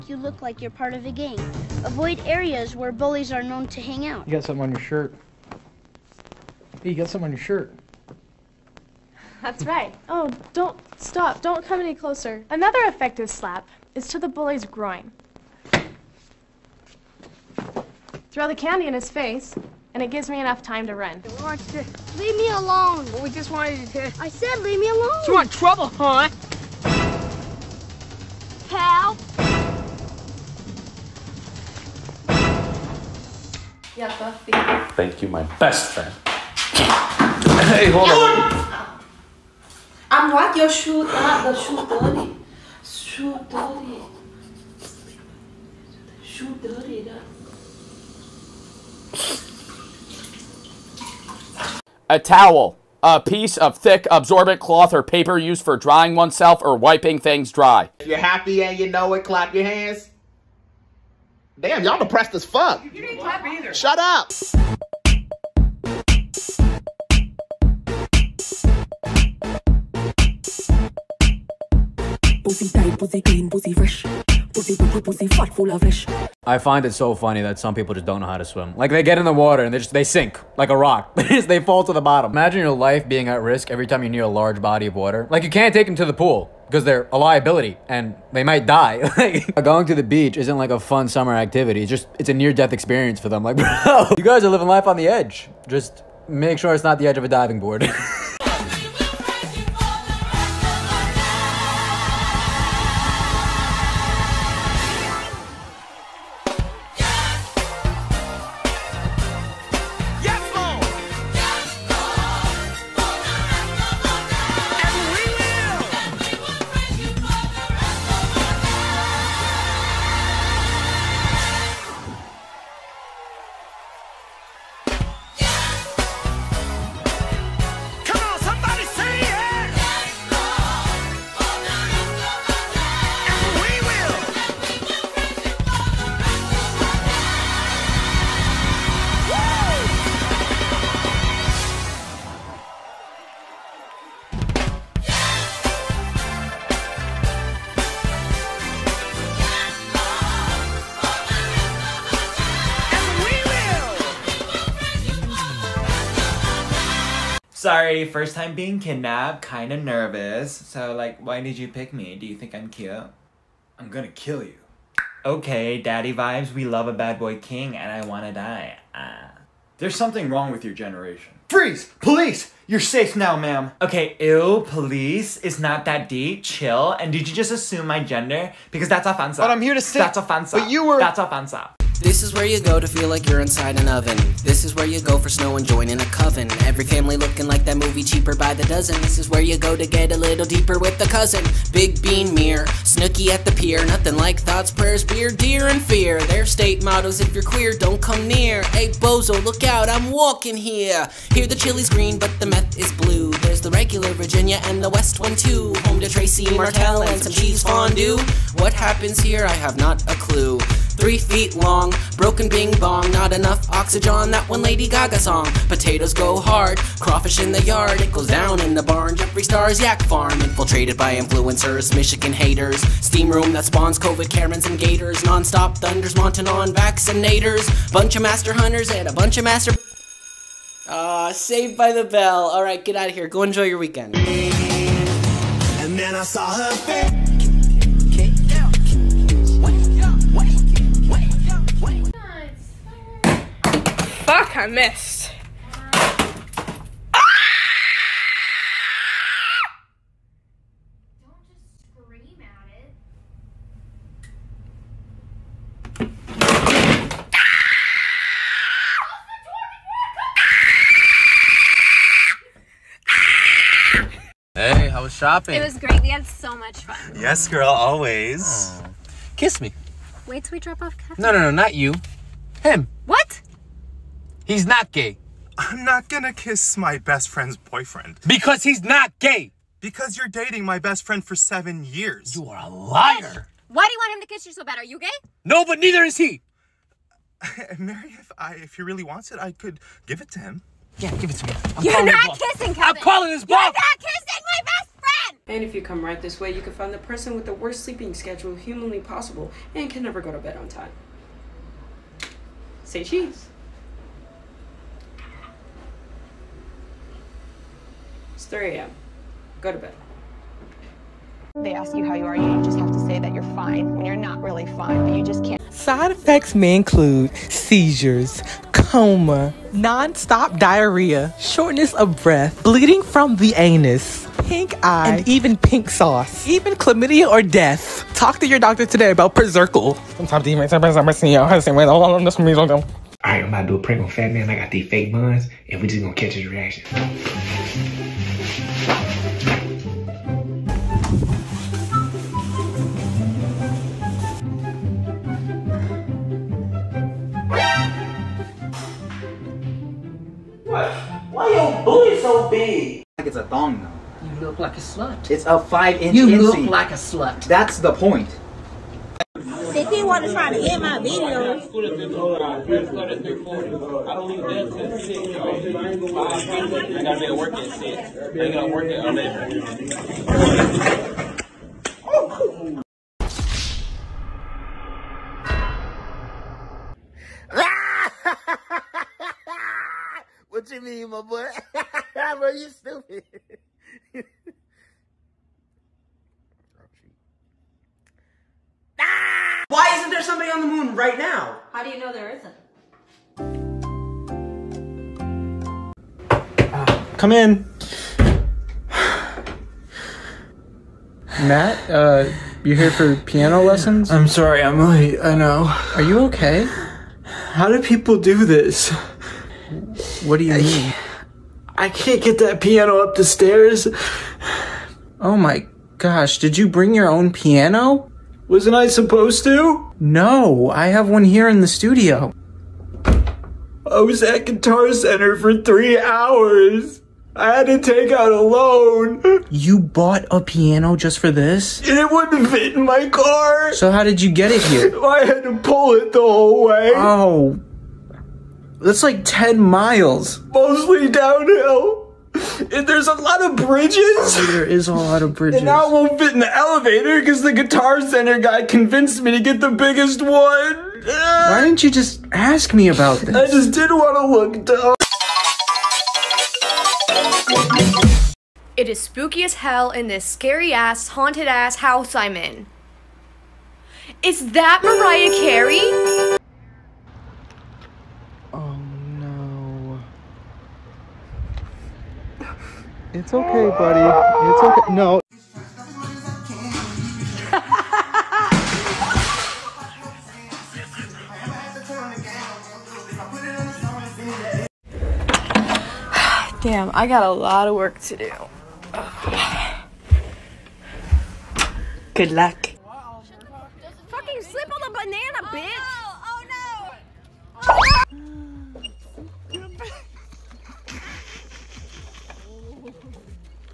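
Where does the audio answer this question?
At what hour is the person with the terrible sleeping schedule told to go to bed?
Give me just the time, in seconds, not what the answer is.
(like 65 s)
308 s.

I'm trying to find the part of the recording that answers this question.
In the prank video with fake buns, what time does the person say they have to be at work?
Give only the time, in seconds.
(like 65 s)
369 s.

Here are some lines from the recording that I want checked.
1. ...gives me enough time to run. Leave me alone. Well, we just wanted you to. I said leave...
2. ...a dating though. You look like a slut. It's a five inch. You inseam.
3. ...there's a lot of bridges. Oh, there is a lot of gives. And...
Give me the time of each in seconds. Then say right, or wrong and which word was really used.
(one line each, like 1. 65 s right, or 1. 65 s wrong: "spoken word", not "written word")
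1. 20 s right
2. 353 s wrong: "thong", not "dating"
3. 442 s wrong: "bridges", not "gives".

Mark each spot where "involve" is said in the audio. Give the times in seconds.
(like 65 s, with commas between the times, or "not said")
not said.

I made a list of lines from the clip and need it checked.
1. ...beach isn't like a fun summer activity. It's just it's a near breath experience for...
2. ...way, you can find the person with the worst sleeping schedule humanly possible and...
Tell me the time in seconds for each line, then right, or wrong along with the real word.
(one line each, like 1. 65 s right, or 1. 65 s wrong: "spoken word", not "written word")
1. 90 s wrong: "death", not "breath"
2. 296 s right.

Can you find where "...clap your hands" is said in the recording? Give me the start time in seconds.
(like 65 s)
59 s.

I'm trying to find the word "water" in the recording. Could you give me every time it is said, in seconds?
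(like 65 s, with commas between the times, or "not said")
79 s, 84 s.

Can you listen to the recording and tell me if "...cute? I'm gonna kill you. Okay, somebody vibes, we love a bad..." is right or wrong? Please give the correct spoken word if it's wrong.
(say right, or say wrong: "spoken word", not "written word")
wrong: "daddy", not "somebody".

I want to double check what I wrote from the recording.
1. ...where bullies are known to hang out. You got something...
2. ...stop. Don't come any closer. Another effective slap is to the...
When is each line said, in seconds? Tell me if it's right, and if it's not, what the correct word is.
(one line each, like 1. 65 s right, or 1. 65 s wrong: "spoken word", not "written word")
1. 2 s right
2. 11 s right.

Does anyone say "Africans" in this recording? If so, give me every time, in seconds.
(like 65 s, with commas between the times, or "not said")
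not said.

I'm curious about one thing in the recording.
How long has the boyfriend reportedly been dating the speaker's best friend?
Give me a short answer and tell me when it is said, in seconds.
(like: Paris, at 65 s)
7 years, at 281 s.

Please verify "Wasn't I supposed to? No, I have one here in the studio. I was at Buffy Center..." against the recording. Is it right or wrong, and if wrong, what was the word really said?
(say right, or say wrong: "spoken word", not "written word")
wrong: "Guitar", not "Buffy".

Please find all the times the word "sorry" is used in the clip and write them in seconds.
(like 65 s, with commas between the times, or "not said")
157 s, 404 s.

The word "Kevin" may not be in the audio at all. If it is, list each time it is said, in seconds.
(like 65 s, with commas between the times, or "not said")
270 s, 292 s.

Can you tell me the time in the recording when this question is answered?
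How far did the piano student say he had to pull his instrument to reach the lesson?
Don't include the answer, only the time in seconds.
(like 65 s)
439 s.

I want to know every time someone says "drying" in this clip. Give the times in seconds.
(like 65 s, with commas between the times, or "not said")
55 s.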